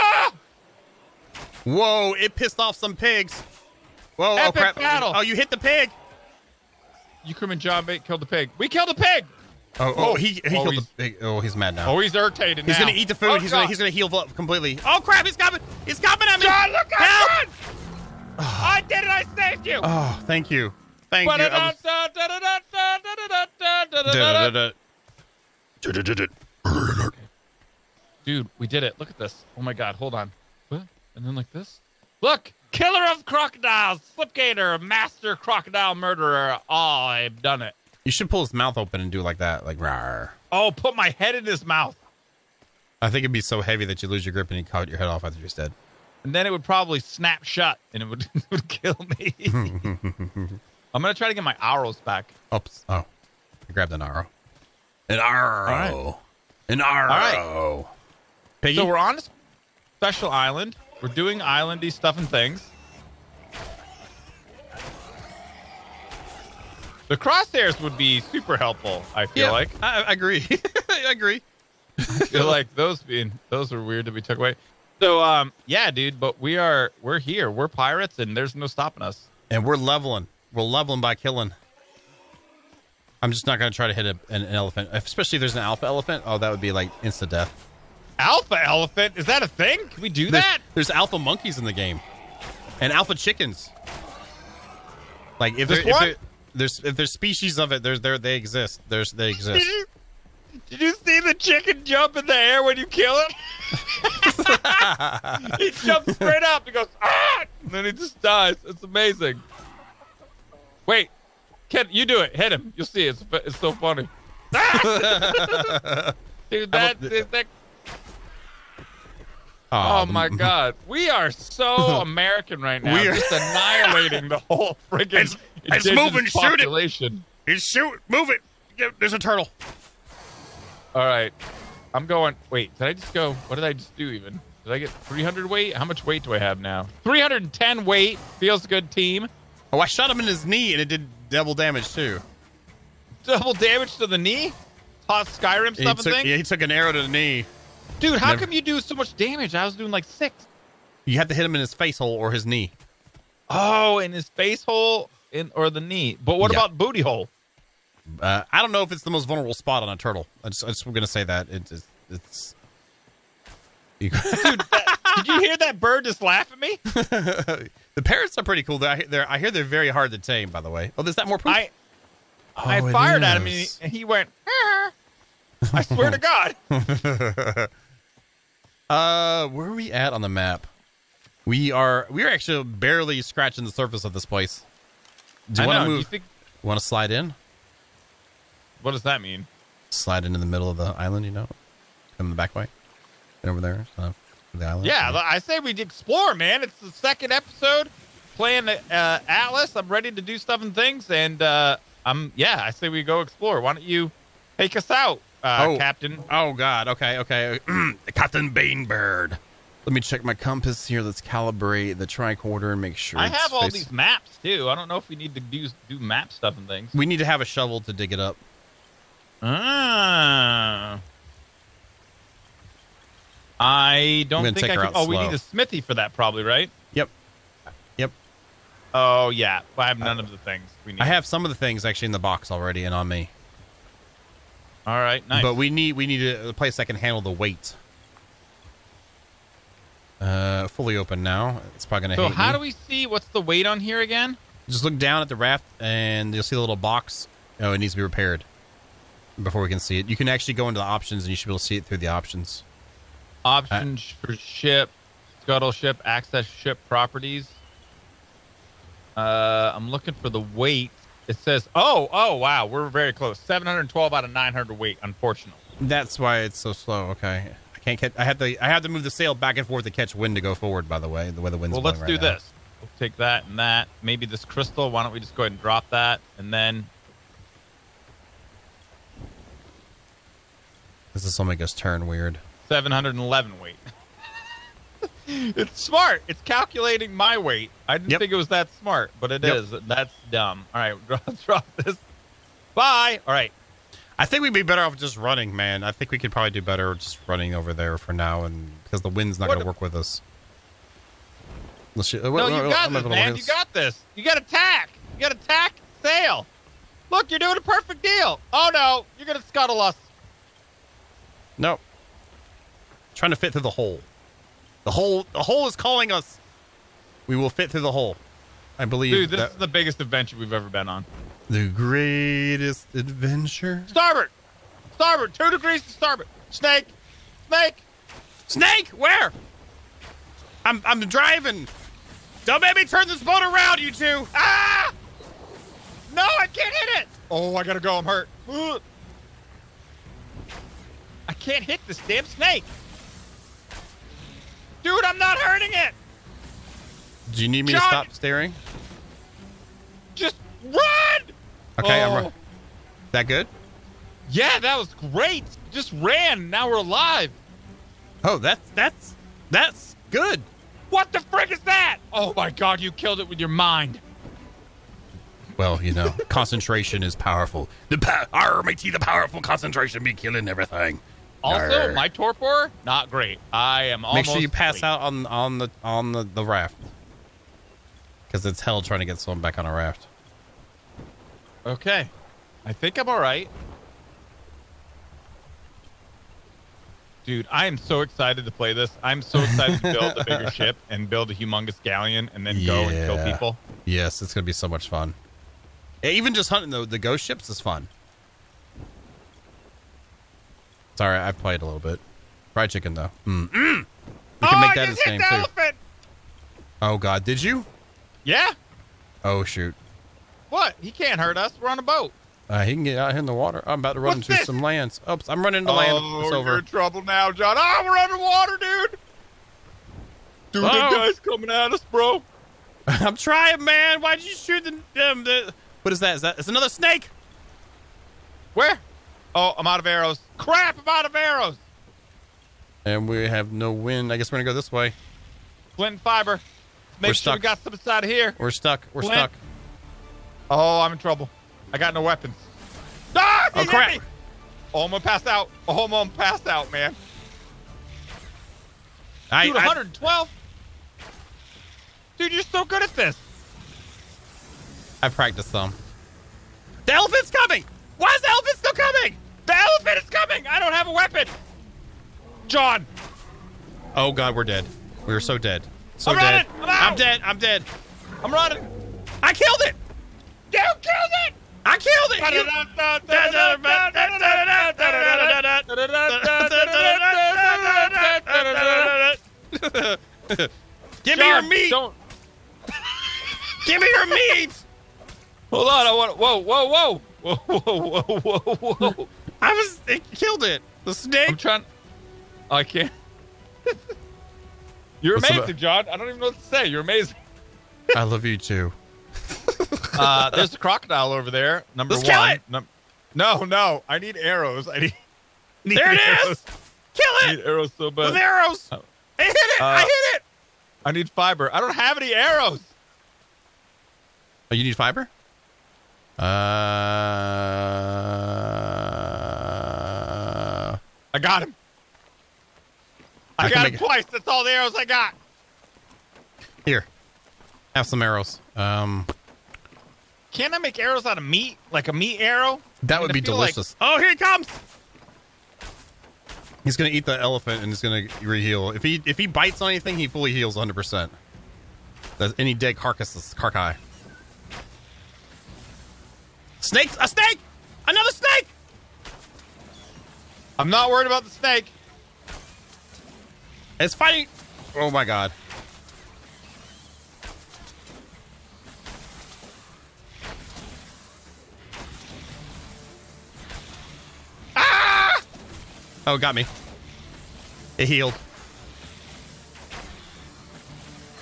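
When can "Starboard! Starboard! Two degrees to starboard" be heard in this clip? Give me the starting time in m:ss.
5:23.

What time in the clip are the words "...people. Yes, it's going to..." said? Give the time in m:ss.
6:33.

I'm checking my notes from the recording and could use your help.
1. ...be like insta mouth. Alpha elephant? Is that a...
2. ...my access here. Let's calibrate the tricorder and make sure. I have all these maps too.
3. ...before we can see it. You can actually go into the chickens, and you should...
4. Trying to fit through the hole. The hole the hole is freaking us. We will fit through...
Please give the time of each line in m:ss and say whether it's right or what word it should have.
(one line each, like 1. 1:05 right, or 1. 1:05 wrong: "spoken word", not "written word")
1. 1:26 wrong: "death", not "mouth"
2. 3:30 wrong: "compass", not "access"
3. 4:09 wrong: "options", not "chickens"
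4. 5:13 wrong: "calling", not "freaking".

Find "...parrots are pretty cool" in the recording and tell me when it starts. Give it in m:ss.
2:48.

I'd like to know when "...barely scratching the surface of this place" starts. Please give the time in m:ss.
3:02.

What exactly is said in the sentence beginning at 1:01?
We're doing islandy stuff and things.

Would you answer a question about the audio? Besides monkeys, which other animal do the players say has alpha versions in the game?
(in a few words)
Chickens.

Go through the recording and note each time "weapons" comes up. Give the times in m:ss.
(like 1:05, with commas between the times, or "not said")
7:22, 7:40.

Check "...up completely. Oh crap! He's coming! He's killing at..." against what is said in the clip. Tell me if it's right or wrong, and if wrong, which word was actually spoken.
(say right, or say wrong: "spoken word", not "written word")
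wrong: "coming", not "killing".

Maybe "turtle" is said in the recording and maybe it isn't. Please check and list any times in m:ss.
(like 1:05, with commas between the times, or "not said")
2:09, 2:39.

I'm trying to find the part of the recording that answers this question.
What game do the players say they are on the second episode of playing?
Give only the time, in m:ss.
3:19.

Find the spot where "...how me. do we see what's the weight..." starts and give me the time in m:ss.
4:02.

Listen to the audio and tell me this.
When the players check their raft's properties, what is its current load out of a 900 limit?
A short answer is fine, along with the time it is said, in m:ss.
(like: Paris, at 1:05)
712, at 4:23.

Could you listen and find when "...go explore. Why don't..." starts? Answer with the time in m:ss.
3:23.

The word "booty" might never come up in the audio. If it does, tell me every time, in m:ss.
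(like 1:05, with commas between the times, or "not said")
2:36.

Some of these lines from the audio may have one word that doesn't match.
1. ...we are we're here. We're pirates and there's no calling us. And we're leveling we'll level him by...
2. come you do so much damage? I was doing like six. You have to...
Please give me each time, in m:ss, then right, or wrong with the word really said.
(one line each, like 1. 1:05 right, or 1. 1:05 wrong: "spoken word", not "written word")
1. 1:16 wrong: "stopping", not "calling"
2. 2:28 right.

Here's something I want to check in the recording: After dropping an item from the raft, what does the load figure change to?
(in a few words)
711.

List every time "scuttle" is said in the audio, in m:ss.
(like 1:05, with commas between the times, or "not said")
4:15, 5:09.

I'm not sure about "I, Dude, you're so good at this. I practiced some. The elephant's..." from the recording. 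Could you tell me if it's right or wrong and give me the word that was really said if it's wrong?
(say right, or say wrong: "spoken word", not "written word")
right.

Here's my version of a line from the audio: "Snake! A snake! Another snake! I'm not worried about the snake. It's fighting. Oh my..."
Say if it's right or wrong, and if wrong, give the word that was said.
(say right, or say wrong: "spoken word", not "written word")
right.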